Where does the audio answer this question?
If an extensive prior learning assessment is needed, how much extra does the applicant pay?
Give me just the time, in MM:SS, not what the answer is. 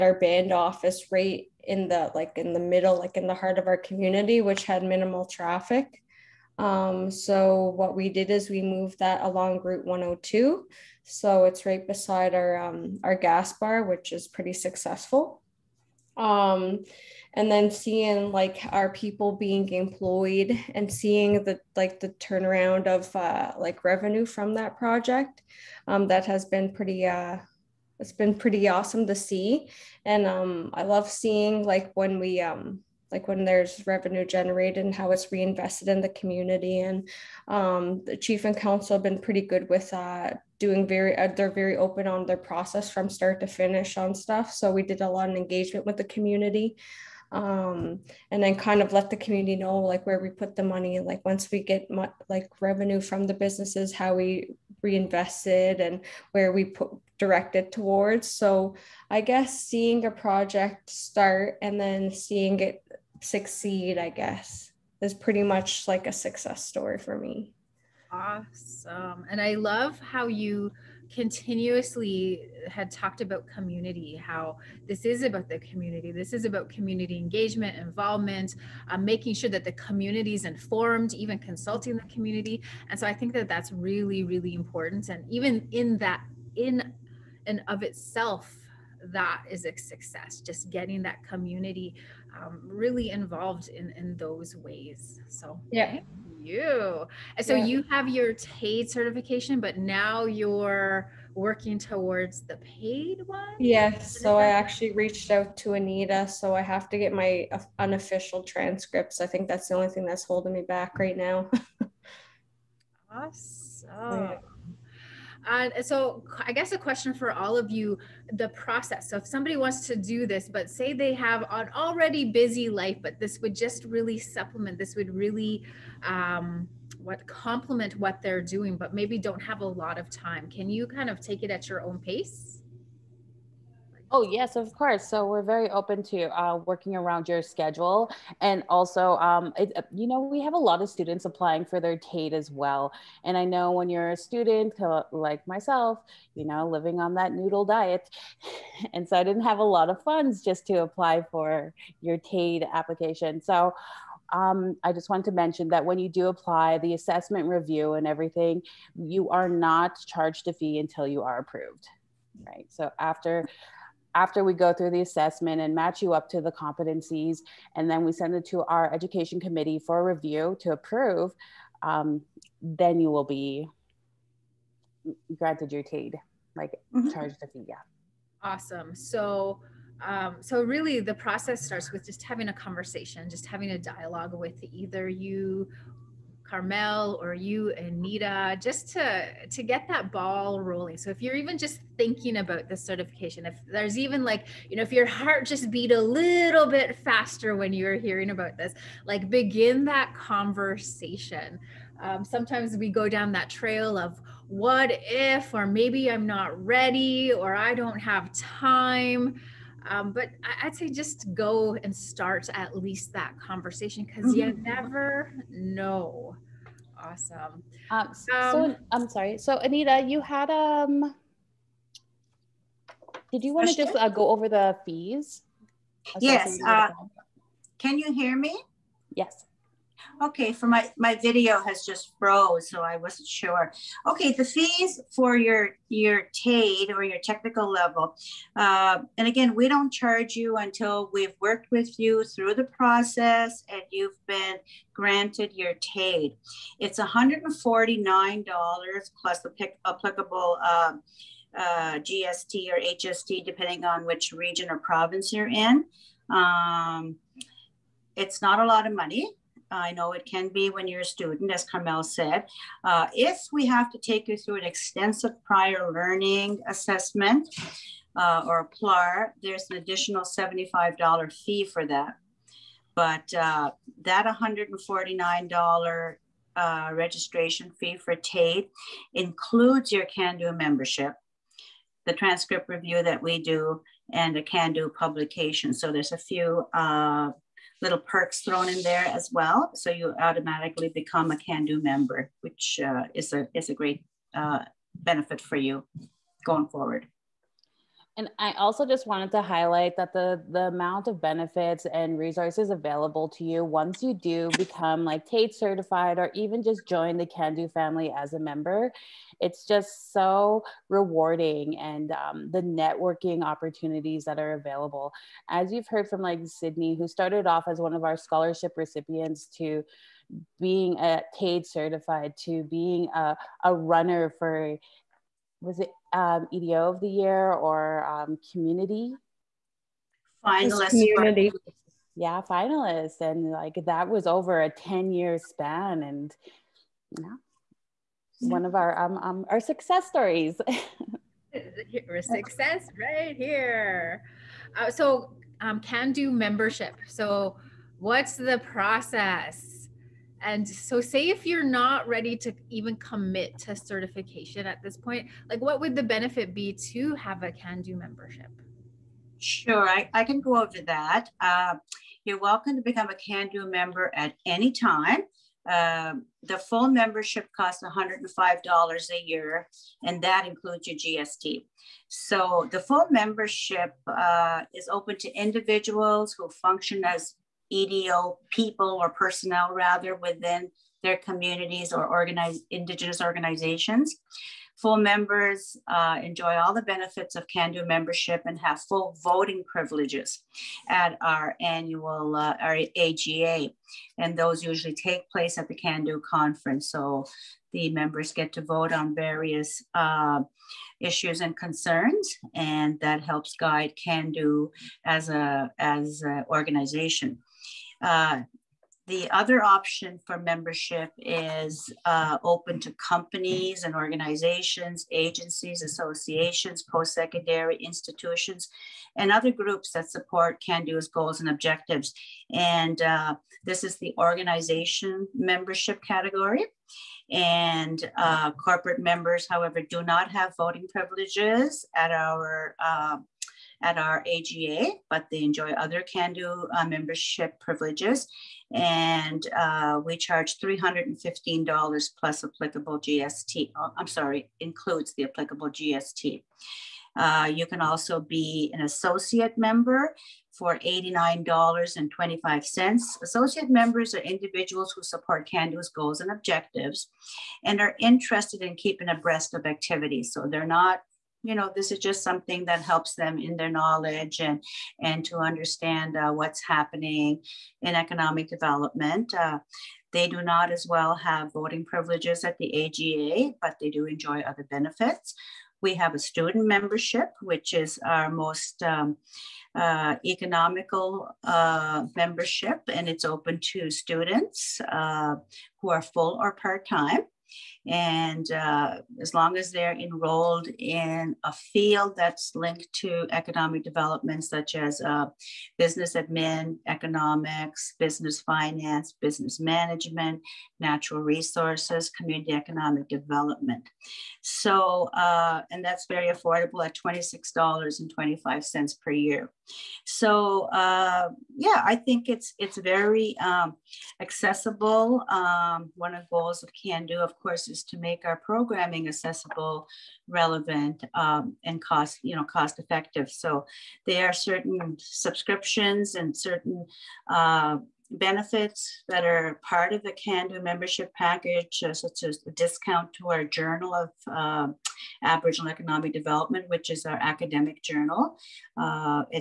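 04:30.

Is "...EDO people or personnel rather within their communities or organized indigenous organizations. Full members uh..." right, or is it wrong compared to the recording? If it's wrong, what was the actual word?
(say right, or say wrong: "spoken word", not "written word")
right.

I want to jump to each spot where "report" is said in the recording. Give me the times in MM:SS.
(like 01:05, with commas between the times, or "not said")
not said.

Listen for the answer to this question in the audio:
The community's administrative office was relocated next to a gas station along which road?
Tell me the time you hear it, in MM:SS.
00:09.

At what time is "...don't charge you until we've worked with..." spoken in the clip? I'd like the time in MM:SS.
03:59.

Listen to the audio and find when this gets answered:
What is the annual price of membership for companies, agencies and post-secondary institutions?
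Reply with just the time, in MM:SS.
07:20.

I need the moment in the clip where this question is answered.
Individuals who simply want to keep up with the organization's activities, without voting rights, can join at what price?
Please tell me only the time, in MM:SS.
07:30.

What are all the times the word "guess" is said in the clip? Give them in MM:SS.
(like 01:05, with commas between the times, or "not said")
00:59, 01:04, 01:56.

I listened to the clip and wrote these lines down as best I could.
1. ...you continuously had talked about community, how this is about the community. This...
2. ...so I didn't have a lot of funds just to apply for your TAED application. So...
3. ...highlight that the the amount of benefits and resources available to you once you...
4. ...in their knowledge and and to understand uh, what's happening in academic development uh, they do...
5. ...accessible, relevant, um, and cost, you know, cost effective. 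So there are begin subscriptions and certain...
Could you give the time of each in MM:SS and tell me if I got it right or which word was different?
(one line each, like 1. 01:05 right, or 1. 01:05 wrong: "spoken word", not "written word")
1. 01:10 right
2. 02:29 right
3. 04:59 right
4. 07:43 wrong: "economic", not "academic"
5. 08:39 wrong: "certain", not "begin".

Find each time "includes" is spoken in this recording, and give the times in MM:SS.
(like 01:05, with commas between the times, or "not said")
04:39, 06:10, 07:24.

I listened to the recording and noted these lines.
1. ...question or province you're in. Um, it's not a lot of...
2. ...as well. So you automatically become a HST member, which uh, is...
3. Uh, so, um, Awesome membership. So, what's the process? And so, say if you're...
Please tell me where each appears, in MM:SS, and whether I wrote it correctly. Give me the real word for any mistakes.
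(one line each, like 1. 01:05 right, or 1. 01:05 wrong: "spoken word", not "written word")
1. 04:14 wrong: "region", not "question"
2. 04:49 wrong: "Cando", not "HST"
3. 05:44 wrong: "Cando", not "Awesome".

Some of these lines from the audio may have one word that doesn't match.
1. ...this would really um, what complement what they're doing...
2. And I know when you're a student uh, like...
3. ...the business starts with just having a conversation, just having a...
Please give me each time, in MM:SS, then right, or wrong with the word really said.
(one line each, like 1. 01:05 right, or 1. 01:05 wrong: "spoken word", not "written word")
1. 02:04 right
2. 02:23 right
3. 03:01 wrong: "process", not "business".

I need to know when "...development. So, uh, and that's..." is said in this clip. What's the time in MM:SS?
08:23.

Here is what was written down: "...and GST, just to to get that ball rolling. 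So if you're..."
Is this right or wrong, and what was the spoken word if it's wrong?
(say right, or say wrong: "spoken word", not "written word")
wrong: "Nita", not "GST".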